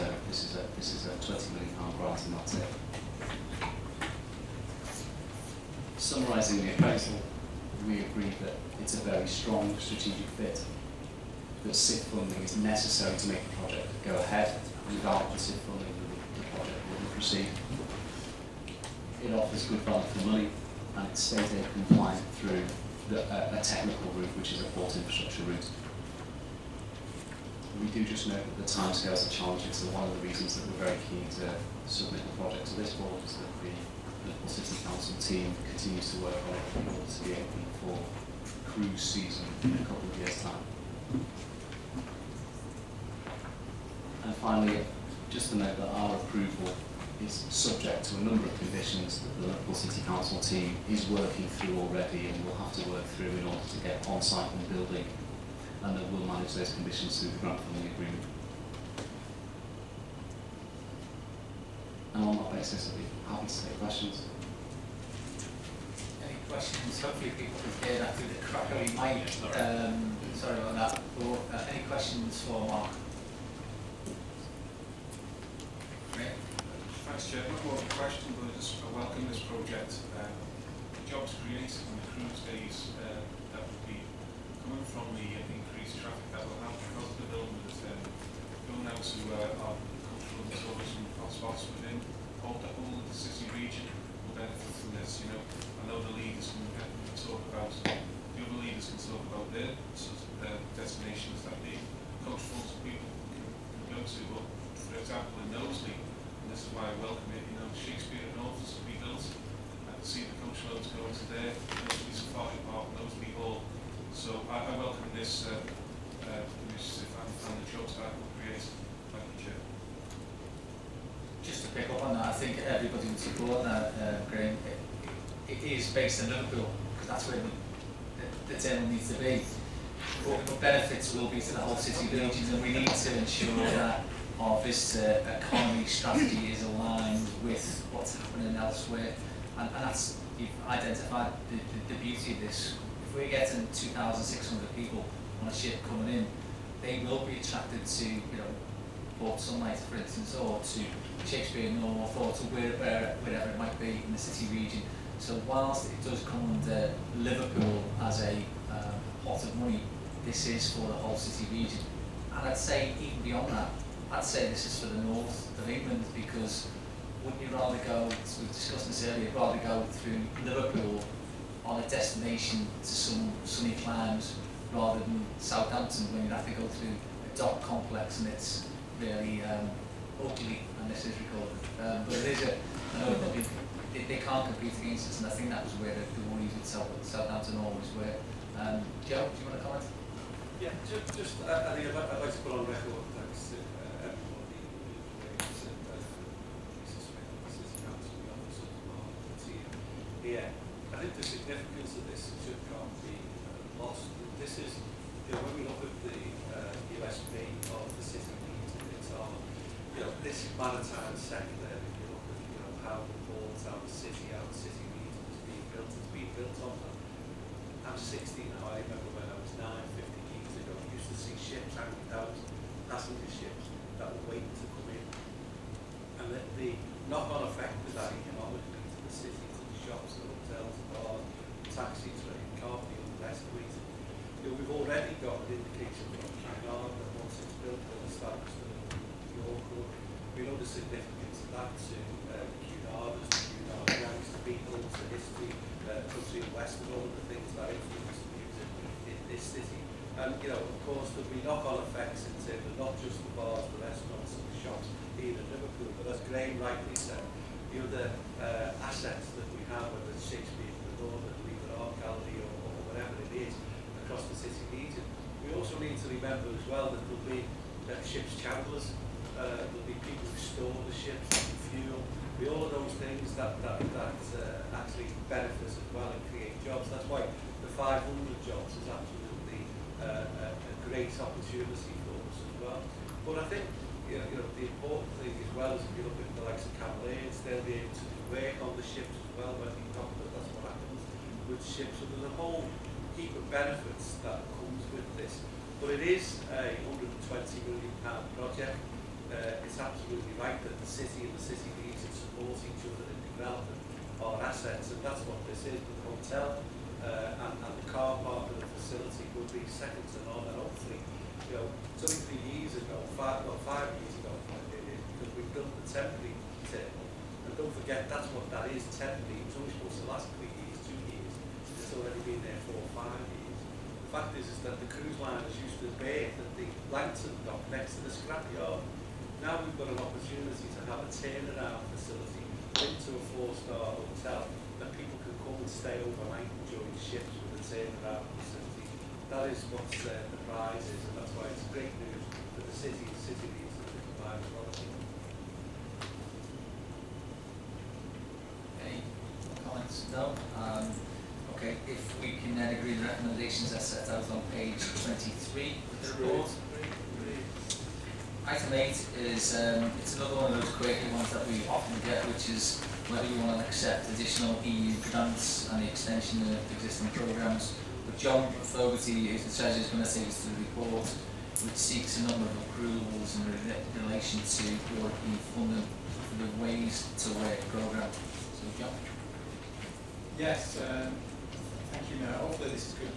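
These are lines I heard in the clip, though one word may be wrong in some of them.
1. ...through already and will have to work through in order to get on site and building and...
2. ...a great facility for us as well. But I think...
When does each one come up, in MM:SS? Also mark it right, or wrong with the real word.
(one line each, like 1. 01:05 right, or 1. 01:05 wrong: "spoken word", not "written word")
1. 00:51 right
2. 04:40 wrong: "opportunity", not "facility".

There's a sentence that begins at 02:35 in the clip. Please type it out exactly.
So whilst it does come under Liverpool as a uh, pot of money, this is for the whole city region.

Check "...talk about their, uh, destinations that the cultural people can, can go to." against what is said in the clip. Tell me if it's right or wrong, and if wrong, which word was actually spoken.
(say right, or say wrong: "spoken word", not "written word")
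right.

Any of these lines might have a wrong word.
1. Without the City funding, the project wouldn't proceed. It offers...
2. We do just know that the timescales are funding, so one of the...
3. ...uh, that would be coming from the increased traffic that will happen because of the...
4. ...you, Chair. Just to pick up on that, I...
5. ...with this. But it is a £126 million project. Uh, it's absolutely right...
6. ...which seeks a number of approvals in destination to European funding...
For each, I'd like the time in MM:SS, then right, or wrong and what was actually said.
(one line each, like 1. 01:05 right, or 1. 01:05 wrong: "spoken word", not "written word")
1. 00:14 wrong: "SIF", not "City"
2. 00:27 wrong: "challenging", not "funding"
3. 01:23 right
4. 01:59 right
5. 04:54 wrong: "120", not "126"
6. 06:11 wrong: "relation", not "destination".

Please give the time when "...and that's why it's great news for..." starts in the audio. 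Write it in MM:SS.
05:41.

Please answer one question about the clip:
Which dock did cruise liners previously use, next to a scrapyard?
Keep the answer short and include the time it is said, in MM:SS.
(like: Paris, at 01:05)
Langton dock, at 05:26.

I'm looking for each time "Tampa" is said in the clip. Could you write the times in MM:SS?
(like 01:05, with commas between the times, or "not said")
not said.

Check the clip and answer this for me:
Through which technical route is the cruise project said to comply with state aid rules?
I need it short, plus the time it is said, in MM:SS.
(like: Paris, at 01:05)
port infrastructure route, at 00:24.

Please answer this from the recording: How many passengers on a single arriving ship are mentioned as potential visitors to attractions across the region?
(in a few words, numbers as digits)
2,600.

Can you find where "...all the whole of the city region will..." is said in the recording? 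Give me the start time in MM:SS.
01:32.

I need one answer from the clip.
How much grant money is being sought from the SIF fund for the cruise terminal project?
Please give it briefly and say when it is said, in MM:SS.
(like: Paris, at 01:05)
£20 million, at 00:01.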